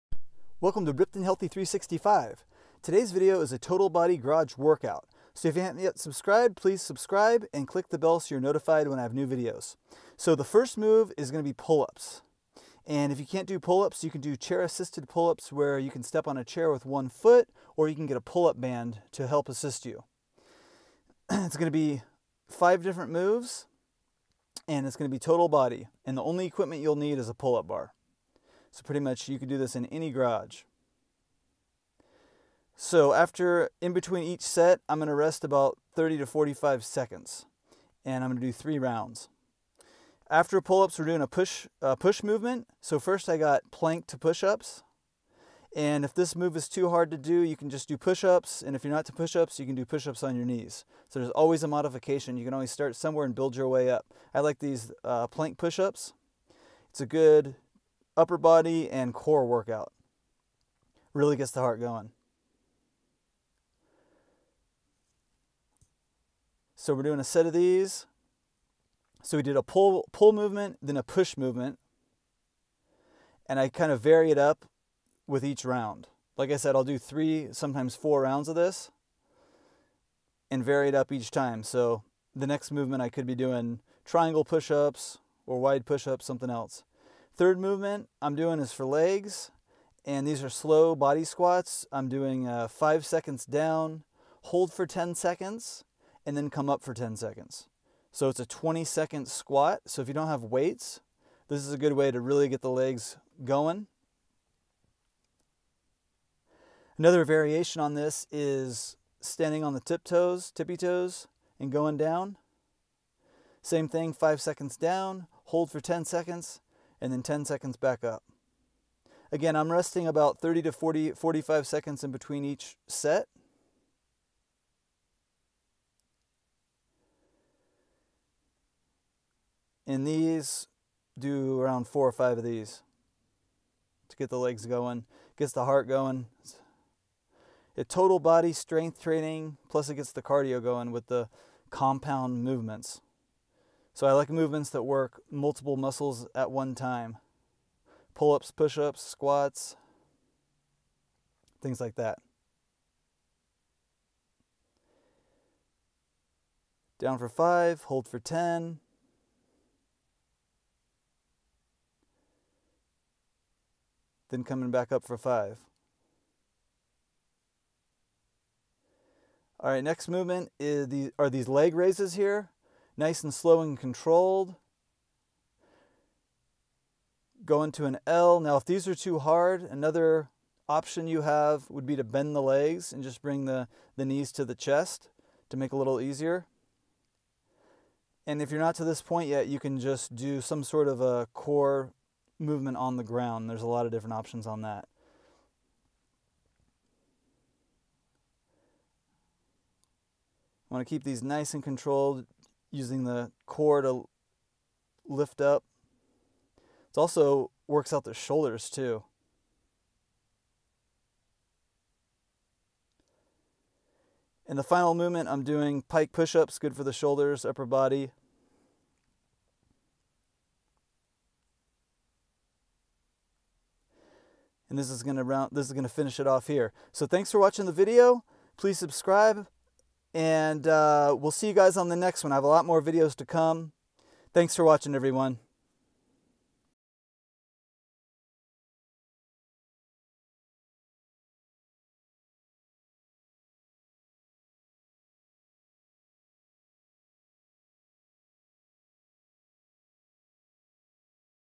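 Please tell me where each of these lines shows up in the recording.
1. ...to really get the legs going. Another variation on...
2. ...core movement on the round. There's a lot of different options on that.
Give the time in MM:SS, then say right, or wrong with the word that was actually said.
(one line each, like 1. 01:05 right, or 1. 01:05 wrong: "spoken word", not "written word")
1. 01:42 right
2. 03:11 wrong: "ground", not "round".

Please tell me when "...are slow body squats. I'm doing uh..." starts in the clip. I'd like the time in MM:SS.
01:30.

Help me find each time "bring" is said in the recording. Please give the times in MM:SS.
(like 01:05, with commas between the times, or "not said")
03:03.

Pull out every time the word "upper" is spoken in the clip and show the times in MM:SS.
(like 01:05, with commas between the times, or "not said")
00:58, 03:37.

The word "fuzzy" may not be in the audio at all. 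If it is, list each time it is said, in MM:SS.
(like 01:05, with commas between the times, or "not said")
not said.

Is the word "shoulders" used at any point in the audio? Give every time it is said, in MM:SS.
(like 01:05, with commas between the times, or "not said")
03:28, 03:36.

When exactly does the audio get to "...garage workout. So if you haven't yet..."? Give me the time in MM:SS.
00:04.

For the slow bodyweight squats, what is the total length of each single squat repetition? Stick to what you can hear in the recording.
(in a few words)
20 seconds.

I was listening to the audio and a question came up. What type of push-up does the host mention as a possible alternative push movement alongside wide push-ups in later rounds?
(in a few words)
triangle push-ups.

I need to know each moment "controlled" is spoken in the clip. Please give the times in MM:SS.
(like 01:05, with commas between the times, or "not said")
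02:53, 03:21.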